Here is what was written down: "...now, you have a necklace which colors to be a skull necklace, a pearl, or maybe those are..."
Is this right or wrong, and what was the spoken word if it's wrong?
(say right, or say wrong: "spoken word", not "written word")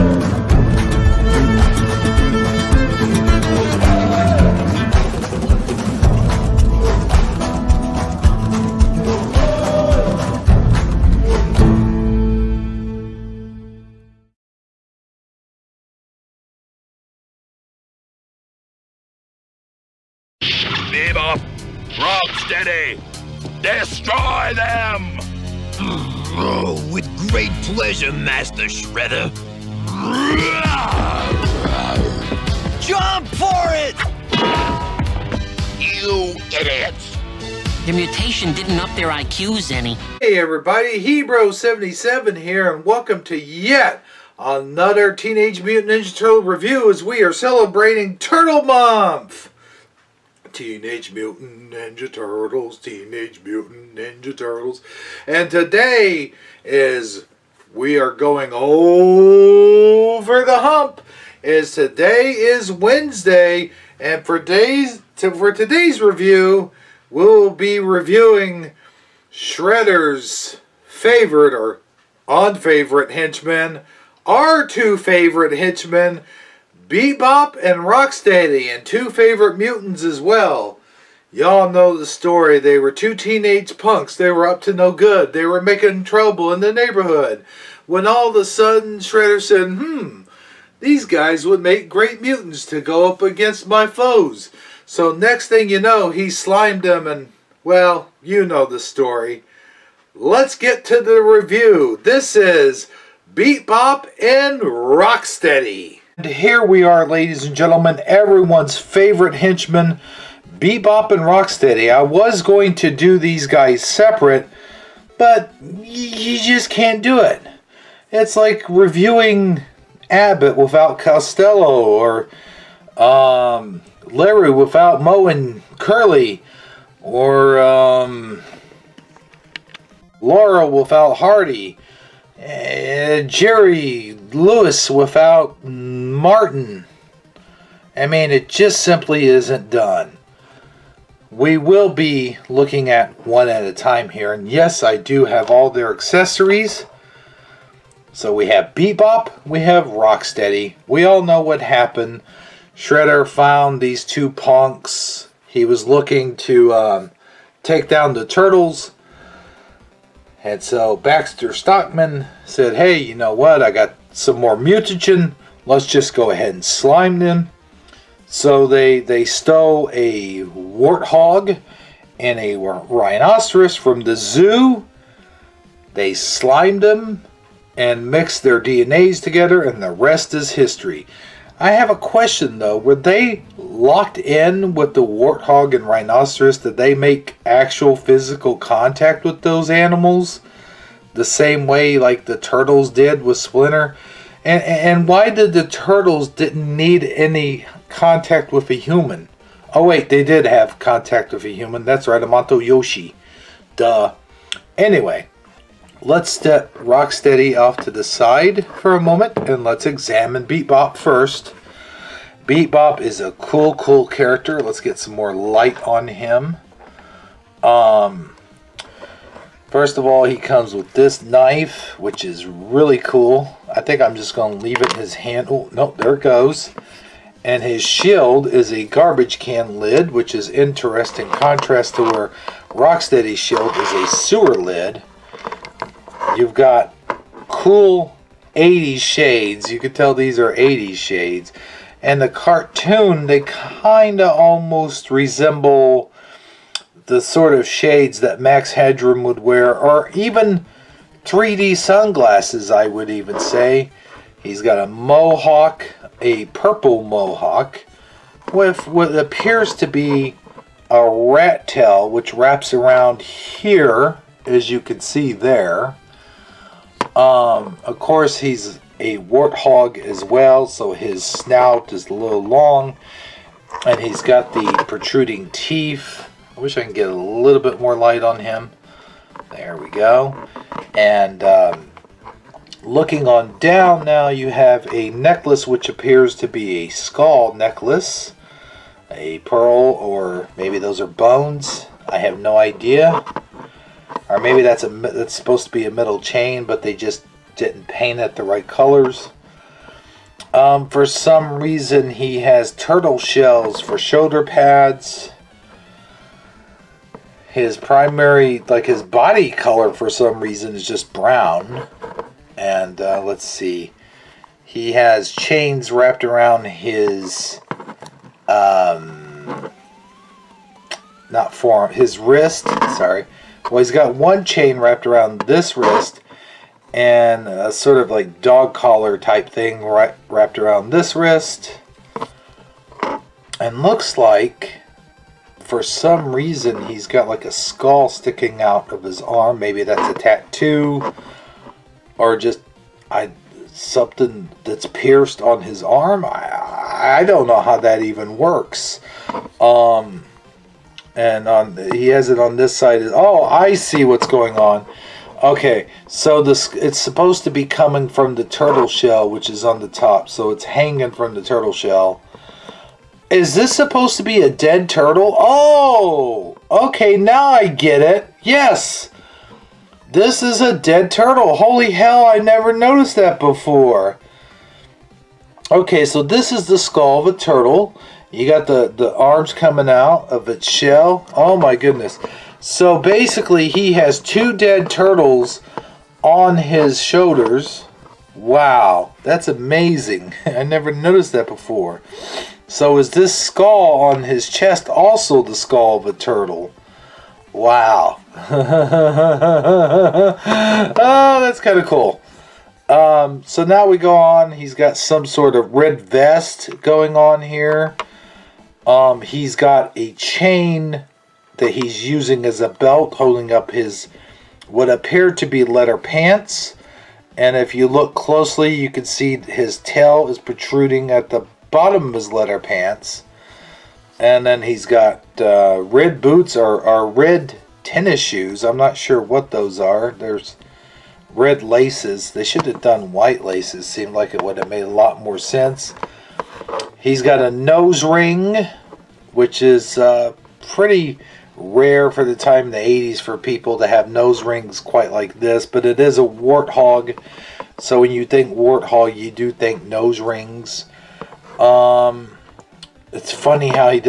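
wrong: "appears", not "colors".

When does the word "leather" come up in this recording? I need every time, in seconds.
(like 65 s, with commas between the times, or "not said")
415 s, 422 s.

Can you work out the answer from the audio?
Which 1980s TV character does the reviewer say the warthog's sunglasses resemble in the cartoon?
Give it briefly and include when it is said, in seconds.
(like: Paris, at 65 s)
Max Headroom, at 248 s.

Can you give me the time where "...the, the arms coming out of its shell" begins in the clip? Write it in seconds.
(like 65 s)
378 s.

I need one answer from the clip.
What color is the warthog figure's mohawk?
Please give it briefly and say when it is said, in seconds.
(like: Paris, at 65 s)
Purple, at 256 s.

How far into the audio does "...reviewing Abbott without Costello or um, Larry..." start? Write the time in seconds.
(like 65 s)
118 s.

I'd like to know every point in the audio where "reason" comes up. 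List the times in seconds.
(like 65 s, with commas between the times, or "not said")
301 s, 310 s, 336 s.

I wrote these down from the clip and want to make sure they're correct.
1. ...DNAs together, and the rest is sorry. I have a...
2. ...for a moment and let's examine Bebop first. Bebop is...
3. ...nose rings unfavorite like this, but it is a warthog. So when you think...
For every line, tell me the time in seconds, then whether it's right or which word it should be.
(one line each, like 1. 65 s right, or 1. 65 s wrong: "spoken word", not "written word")
1. 178 s wrong: "history", not "sorry"
2. 208 s right
3. 444 s wrong: "quite", not "unfavorite".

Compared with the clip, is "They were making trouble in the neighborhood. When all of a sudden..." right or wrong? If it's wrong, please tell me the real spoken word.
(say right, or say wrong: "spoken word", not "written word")
right.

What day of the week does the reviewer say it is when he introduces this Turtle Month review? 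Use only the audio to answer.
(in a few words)
Wednesday.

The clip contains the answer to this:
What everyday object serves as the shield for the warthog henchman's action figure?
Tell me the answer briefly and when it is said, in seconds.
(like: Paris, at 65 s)
A garbage can lid, at 228 s.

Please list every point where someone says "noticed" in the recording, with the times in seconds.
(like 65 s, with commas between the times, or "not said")
372 s, 390 s.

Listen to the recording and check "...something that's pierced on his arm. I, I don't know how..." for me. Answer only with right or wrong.
right.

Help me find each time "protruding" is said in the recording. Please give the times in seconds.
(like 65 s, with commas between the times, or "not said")
274 s, 420 s.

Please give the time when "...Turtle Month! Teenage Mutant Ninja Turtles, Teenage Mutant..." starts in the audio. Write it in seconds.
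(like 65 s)
48 s.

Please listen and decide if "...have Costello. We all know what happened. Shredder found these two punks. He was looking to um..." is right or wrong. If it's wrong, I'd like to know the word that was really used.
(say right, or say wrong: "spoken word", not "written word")
wrong: "Rocksteady", not "Costello".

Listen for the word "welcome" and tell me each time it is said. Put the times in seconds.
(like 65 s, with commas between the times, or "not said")
42 s.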